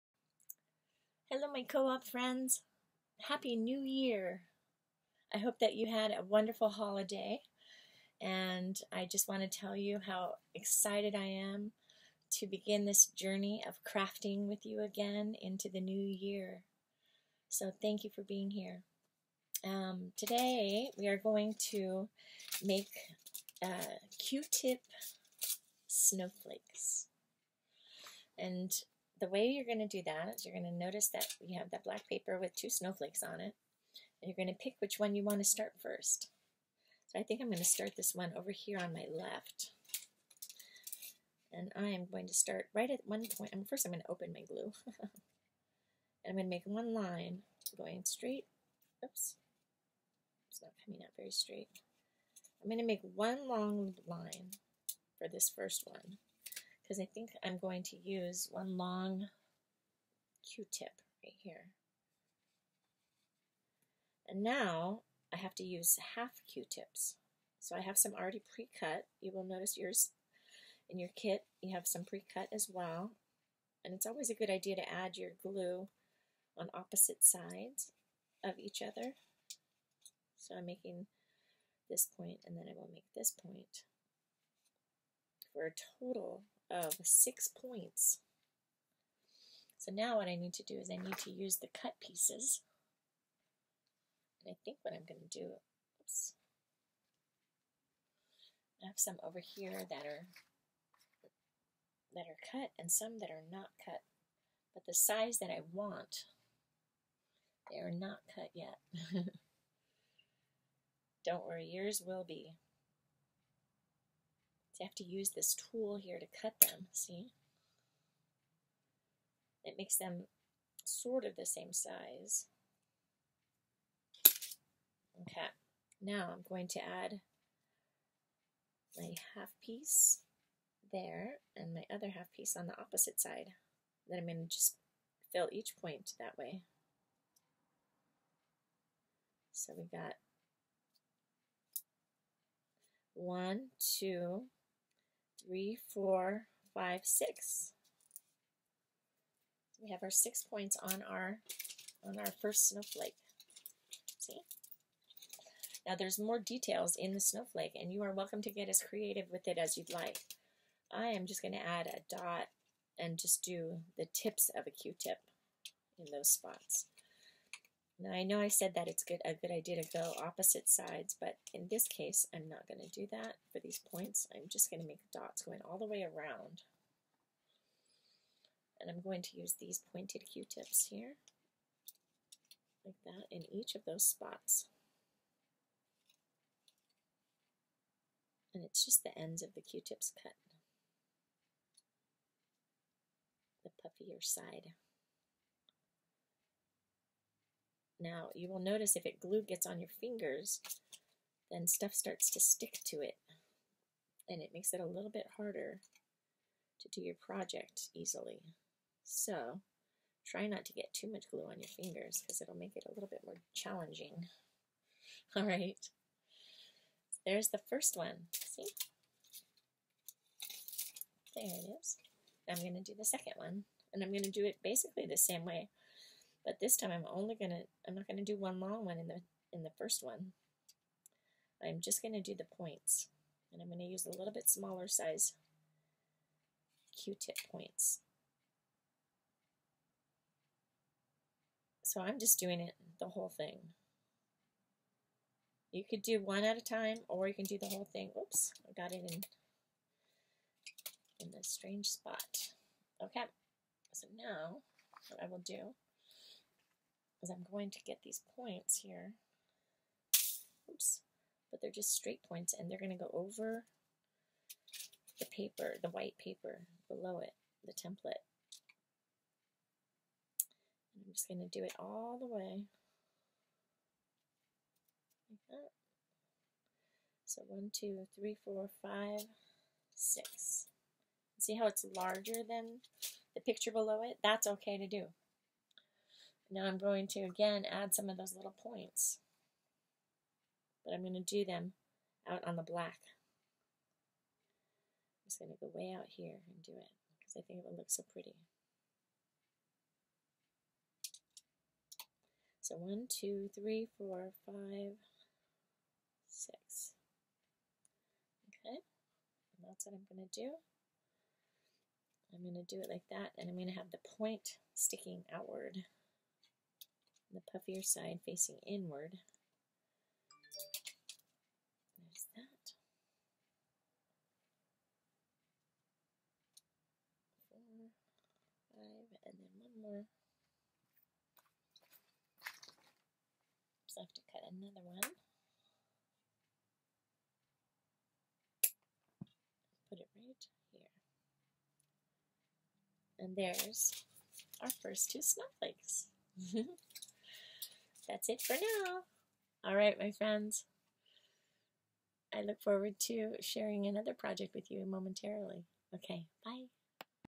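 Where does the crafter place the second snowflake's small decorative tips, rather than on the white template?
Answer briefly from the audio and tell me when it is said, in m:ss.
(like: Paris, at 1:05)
out on the black, at 4:52.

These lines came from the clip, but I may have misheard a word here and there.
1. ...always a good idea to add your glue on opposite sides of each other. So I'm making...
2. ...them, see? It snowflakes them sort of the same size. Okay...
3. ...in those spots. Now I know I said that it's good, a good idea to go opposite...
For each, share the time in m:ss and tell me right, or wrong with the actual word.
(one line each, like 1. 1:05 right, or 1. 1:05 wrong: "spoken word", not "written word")
1. 1:14 right
2. 1:56 wrong: "makes", not "snowflakes"
3. 2:45 right.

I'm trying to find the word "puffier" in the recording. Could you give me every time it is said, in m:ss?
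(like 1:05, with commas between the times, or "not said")
3:13, 5:17.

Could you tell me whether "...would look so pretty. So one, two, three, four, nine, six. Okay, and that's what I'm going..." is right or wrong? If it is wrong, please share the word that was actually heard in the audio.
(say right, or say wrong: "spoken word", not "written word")
wrong: "five", not "nine".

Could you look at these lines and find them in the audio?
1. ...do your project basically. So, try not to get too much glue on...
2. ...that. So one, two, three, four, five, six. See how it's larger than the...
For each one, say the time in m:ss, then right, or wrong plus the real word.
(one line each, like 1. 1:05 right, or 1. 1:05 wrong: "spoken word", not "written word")
1. 3:26 wrong: "easily", not "basically"
2. 4:35 right.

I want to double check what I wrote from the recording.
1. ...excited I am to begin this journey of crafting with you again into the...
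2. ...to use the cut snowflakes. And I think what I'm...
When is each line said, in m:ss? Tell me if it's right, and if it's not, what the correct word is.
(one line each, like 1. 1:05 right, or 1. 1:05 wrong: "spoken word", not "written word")
1. 0:10 right
2. 1:31 wrong: "pieces", not "snowflakes".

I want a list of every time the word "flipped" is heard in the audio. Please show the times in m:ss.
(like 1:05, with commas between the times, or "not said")
not said.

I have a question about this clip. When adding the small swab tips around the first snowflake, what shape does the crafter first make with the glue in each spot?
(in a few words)
a dot.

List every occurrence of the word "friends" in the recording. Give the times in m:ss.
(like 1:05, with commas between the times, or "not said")
0:02, 5:50.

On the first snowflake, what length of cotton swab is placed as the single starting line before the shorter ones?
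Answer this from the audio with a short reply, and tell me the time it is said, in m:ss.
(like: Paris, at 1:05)
one long q-tip, at 0:58.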